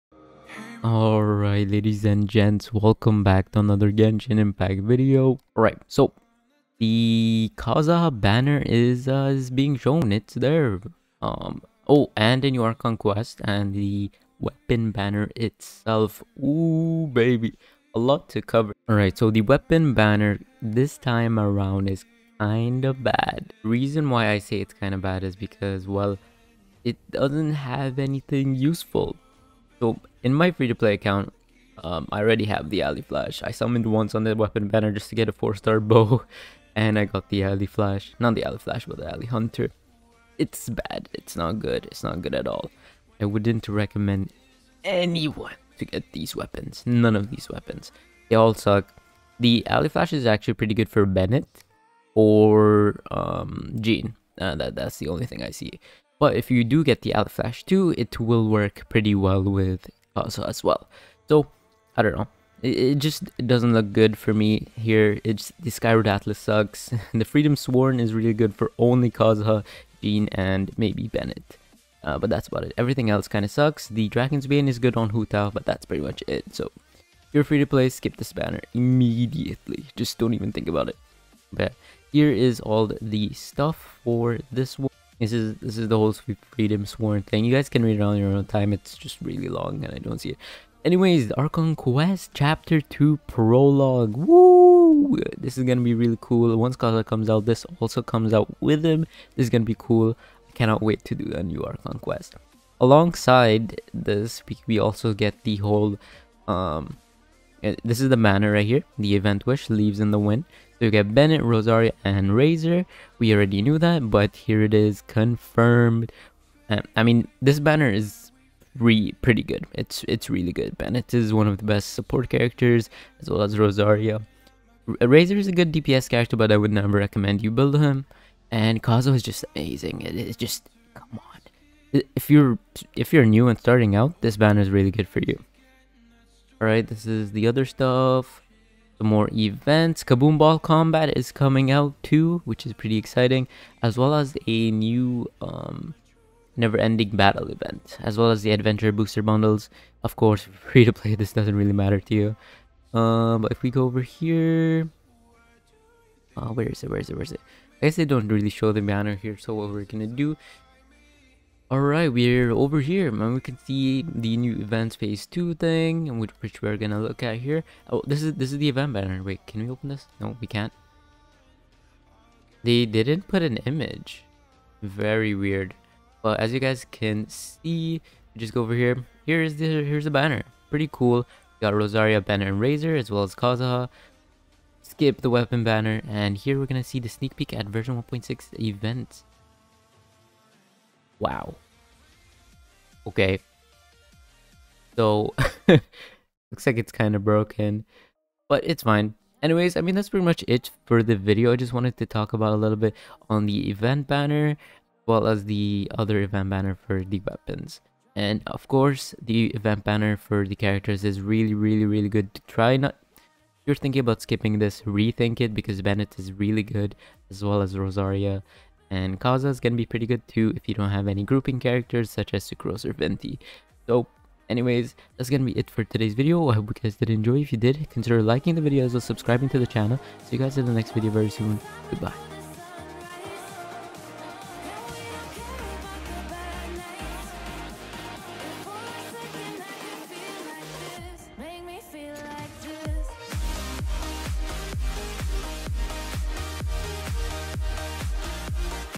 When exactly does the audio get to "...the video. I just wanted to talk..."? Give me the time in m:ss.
3:21.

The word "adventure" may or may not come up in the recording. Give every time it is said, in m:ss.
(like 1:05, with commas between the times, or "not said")
2:28.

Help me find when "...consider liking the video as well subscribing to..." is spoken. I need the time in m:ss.
3:47.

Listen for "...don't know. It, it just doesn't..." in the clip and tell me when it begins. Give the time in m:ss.
1:02.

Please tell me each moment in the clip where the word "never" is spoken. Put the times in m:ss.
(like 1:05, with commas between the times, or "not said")
2:06, 2:26.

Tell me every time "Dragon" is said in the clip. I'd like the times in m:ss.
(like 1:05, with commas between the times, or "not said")
1:14.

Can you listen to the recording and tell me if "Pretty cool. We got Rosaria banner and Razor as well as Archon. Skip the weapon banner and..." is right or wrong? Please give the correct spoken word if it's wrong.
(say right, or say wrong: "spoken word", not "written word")
wrong: "Kazuha", not "Archon".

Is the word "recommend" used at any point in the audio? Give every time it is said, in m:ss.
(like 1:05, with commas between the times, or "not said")
0:43, 2:07.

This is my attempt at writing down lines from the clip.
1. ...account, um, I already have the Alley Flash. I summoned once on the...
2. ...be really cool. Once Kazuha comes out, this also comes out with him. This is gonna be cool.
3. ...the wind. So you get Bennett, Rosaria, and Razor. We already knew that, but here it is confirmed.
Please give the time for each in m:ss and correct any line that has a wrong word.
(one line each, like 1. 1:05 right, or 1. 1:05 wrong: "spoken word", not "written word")
1. 0:30 right
2. 1:35 right
3. 1:50 right.